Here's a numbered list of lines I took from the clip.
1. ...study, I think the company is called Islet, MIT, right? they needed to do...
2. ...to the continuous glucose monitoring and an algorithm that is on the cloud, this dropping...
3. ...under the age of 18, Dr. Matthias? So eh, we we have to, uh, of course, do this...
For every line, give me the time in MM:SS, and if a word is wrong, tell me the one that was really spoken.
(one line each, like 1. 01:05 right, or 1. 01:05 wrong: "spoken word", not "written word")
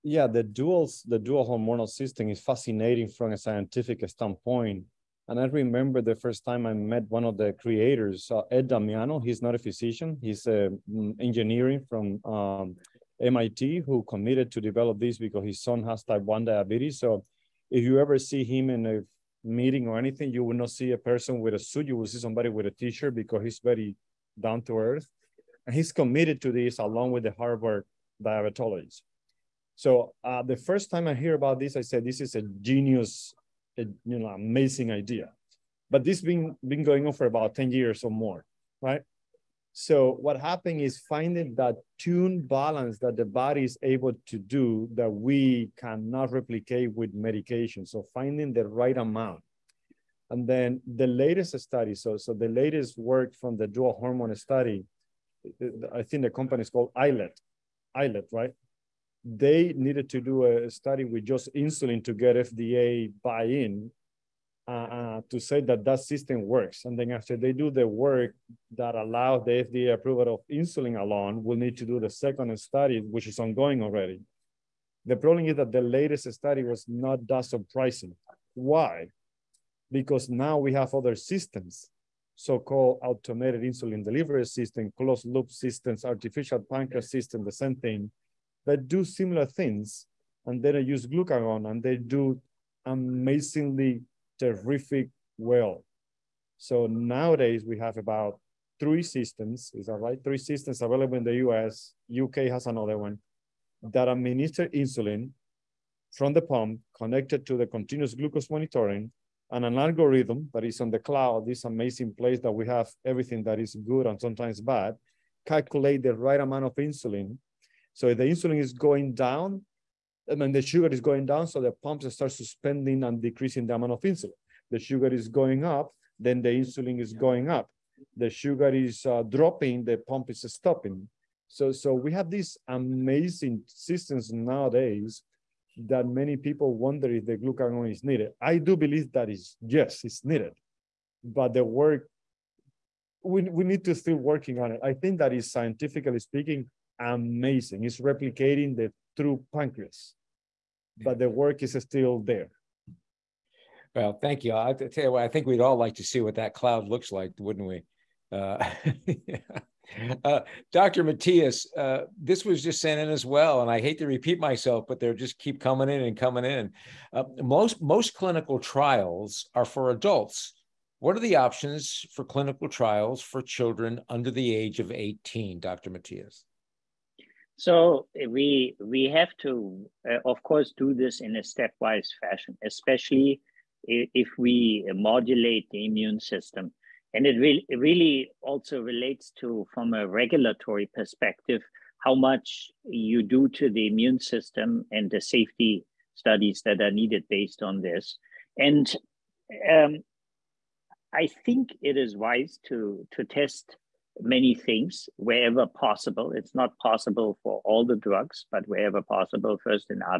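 1. 00:54 wrong: "Islet", not "MIT"
2. 01:47 wrong: "amazing", not "dropping"
3. 02:54 right.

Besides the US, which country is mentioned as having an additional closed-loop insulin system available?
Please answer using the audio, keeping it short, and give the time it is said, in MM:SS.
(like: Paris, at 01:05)
UK, at 01:42.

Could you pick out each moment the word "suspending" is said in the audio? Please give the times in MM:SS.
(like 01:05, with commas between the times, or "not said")
02:02.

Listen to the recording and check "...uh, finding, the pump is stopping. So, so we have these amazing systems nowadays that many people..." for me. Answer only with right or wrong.
wrong.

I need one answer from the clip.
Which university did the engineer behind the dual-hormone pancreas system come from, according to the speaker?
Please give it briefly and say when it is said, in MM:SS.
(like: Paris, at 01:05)
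MIT, at 00:13.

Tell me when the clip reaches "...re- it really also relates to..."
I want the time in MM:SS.
03:07.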